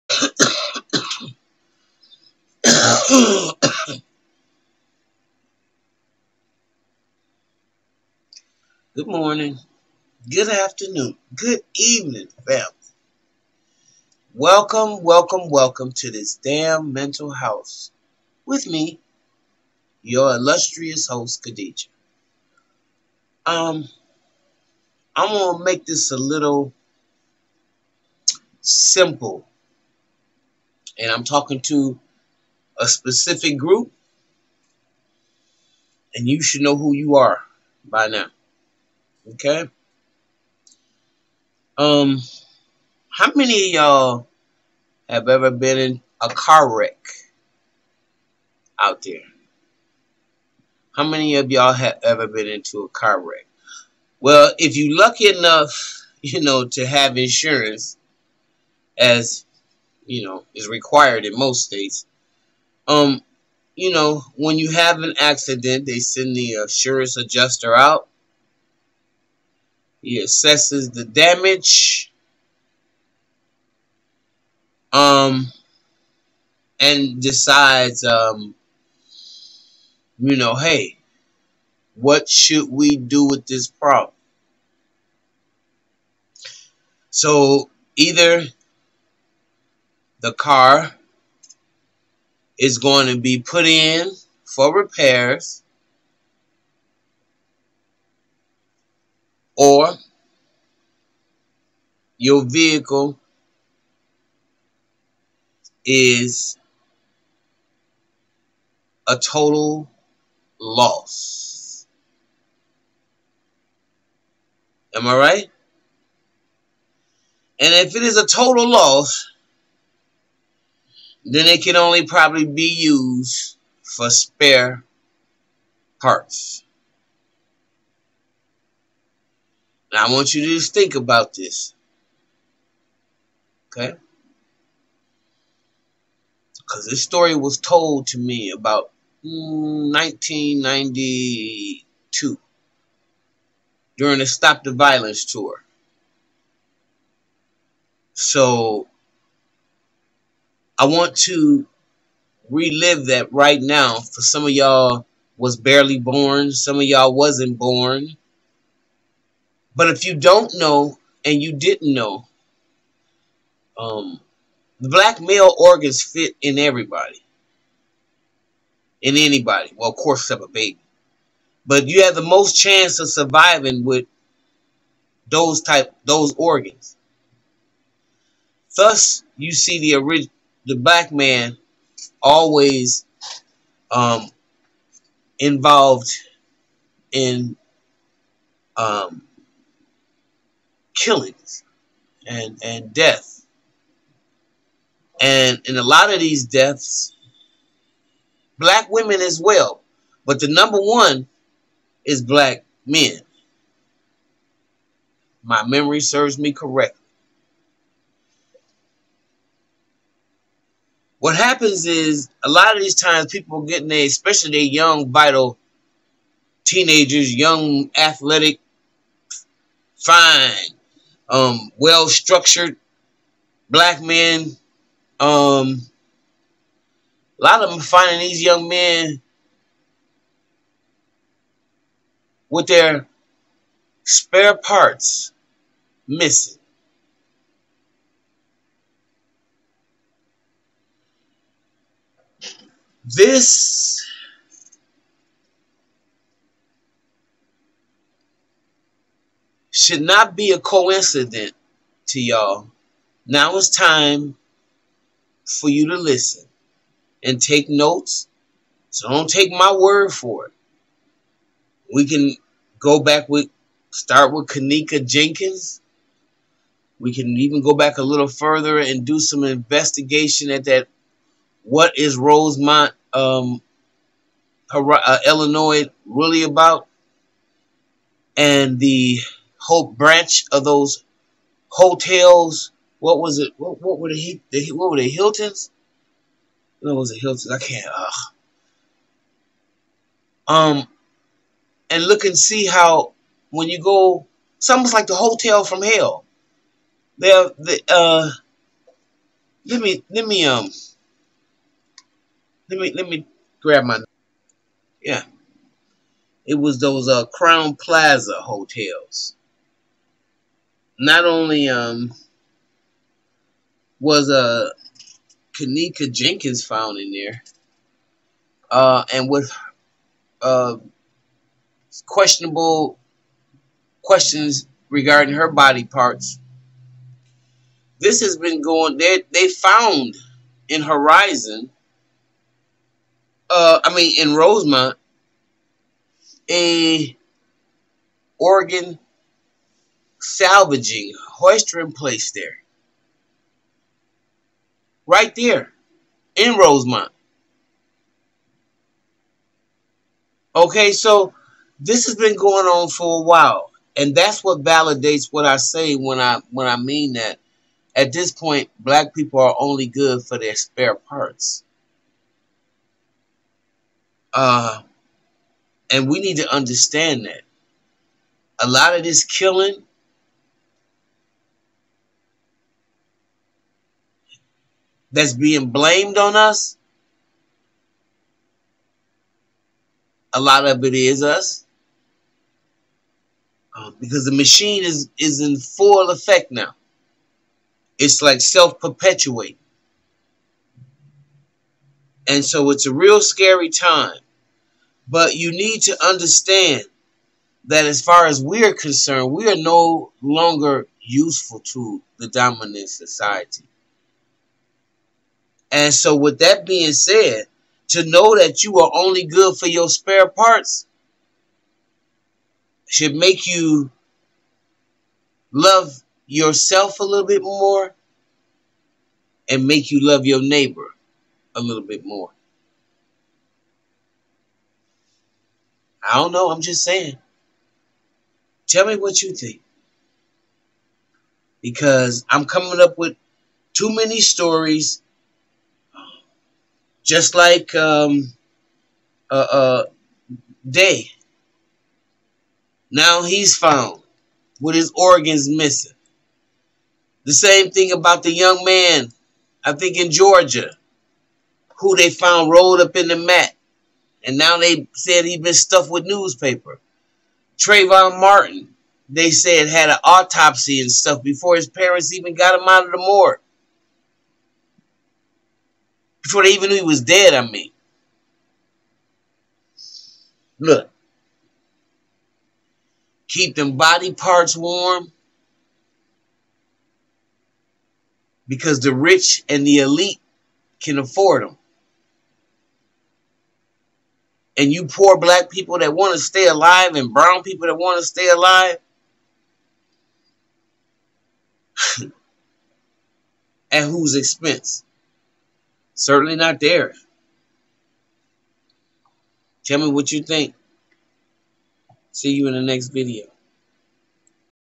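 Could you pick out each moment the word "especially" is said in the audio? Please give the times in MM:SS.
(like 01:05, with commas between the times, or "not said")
03:34.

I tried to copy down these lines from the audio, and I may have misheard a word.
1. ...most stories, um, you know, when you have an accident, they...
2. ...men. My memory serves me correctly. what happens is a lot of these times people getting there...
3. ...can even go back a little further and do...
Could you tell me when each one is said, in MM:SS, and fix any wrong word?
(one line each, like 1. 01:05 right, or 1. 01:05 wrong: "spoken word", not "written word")
1. 01:01 wrong: "states", not "stories"
2. 03:22 right
3. 04:27 right.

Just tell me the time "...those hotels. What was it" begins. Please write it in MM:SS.
04:40.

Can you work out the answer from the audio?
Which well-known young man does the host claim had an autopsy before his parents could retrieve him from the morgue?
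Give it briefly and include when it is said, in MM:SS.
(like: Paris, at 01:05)
Trayvon Martin, at 07:37.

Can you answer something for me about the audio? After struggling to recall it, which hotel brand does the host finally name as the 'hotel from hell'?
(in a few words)
Crowne Plaza.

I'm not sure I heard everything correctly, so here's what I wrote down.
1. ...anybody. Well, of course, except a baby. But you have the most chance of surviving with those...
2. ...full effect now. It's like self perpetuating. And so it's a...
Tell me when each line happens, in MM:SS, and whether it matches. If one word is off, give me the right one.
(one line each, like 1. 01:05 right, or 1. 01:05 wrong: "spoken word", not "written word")
1. 02:49 right
2. 06:25 right.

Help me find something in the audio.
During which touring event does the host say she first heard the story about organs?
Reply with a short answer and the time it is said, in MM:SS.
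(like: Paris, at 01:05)
Stop the Violence tour, at 02:24.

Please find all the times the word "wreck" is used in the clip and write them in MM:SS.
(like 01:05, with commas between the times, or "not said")
00:46, 00:53.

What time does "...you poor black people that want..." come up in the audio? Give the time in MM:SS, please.
08:04.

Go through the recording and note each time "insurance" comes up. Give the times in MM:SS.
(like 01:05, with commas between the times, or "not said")
00:57, 01:06.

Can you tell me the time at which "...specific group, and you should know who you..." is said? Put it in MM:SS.
00:32.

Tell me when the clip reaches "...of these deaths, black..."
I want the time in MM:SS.
03:16.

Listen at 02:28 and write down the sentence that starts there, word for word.
So I want to relive that right now for some of y'all was barely born, some of y'all wasn't born.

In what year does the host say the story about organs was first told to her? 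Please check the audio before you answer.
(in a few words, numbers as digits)
1992.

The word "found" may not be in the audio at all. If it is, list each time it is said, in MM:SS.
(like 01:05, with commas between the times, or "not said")
05:16, 05:29, 07:23, 07:32.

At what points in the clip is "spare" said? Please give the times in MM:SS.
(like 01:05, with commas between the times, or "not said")
02:04, 03:54, 06:00, 06:49.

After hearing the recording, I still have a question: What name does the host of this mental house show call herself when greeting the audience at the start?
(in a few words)
Khadijah.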